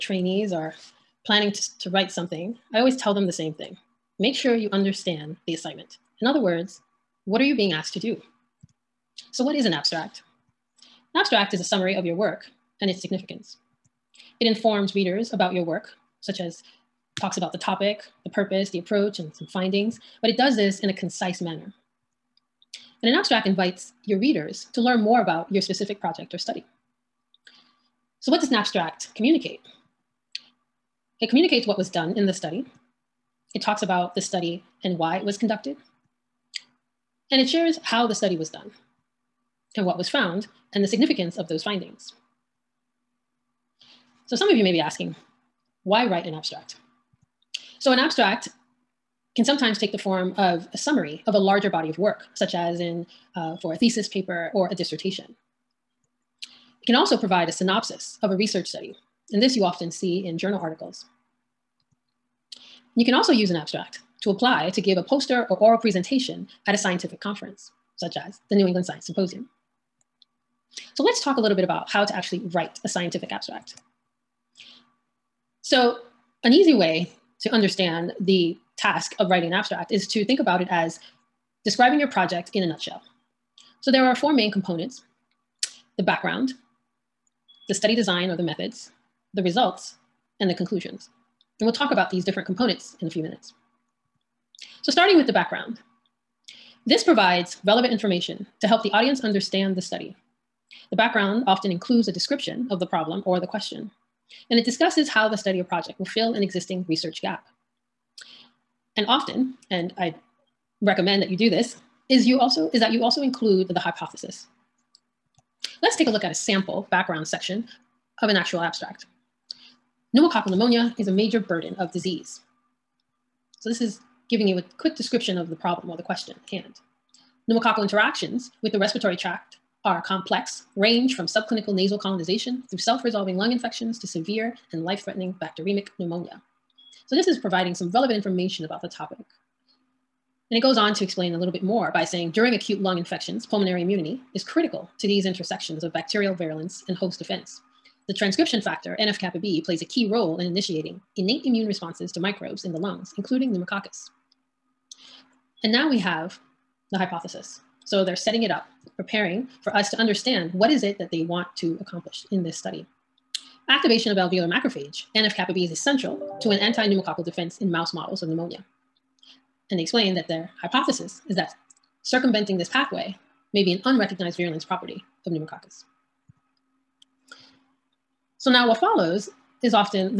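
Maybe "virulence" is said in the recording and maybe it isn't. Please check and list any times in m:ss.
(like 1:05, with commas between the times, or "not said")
2:26, 2:54.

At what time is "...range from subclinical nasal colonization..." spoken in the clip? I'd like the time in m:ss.
2:10.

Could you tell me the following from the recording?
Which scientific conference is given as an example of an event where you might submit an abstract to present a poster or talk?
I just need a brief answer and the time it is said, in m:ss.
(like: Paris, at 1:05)
New England Science Symposium, at 1:08.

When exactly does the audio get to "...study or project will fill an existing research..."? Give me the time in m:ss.
1:45.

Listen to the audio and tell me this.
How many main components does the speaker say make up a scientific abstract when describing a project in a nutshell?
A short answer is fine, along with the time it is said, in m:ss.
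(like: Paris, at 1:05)
4, at 1:24.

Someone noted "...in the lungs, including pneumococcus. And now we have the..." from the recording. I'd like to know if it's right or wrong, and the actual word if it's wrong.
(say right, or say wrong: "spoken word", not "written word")
right.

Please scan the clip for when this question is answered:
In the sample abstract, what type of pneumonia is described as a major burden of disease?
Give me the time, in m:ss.
2:00.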